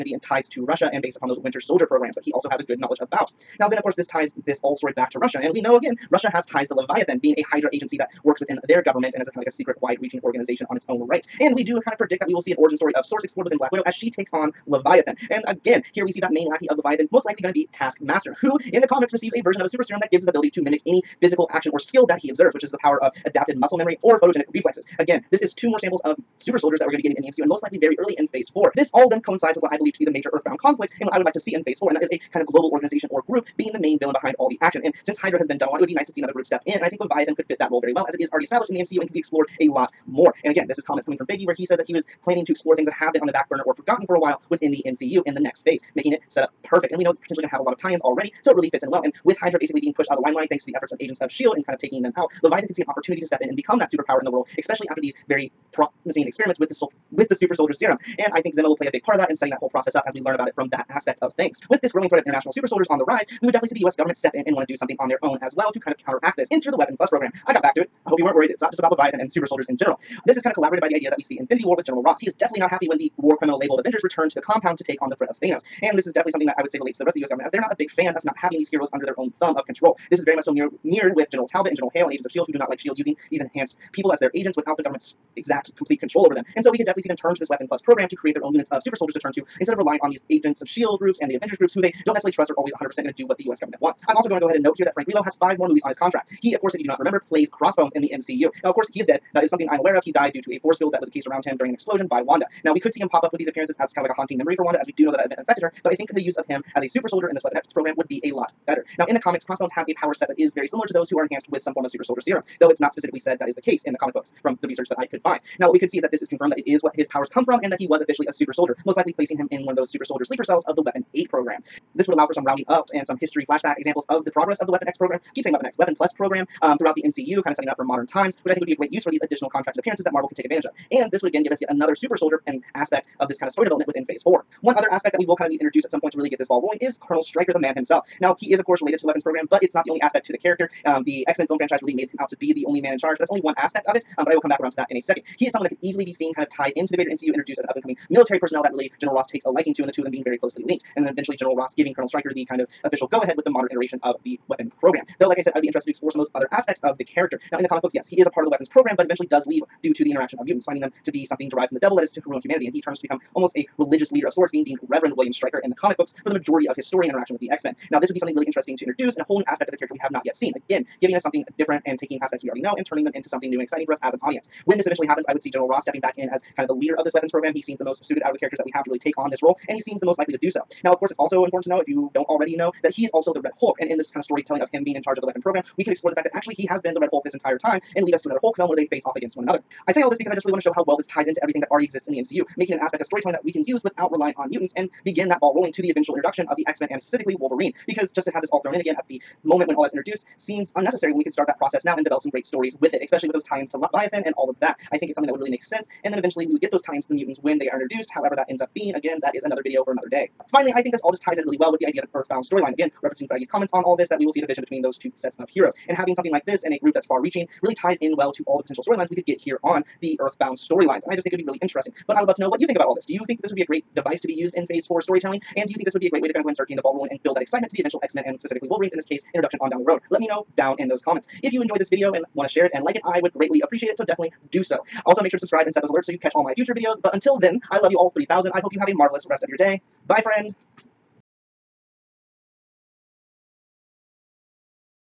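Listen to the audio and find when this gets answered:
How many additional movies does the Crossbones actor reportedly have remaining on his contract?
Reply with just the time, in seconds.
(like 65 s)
95 s.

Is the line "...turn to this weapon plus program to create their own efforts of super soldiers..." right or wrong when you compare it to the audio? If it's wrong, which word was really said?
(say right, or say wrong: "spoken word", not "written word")
wrong: "units", not "efforts".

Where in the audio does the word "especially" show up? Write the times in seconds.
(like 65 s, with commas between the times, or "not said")
54 s, 203 s.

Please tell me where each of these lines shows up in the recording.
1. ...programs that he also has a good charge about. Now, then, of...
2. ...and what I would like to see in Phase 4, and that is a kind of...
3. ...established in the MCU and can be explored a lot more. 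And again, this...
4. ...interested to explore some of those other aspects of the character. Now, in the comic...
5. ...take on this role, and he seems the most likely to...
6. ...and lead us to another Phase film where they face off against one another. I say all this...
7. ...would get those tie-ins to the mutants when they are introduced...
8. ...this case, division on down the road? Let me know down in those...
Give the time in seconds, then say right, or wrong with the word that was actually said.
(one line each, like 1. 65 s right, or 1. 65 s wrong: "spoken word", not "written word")
1. 1 s wrong: "knowledge", not "charge"
2. 31 s right
3. 38 s right
4. 155 s right
5. 179 s right
6. 187 s wrong: "Hulk", not "Phase"
7. 206 s right
8. 228 s wrong: "introduction", not "division".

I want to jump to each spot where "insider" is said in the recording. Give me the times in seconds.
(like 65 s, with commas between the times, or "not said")
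not said.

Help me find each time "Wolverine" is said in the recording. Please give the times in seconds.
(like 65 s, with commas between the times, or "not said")
197 s, 228 s.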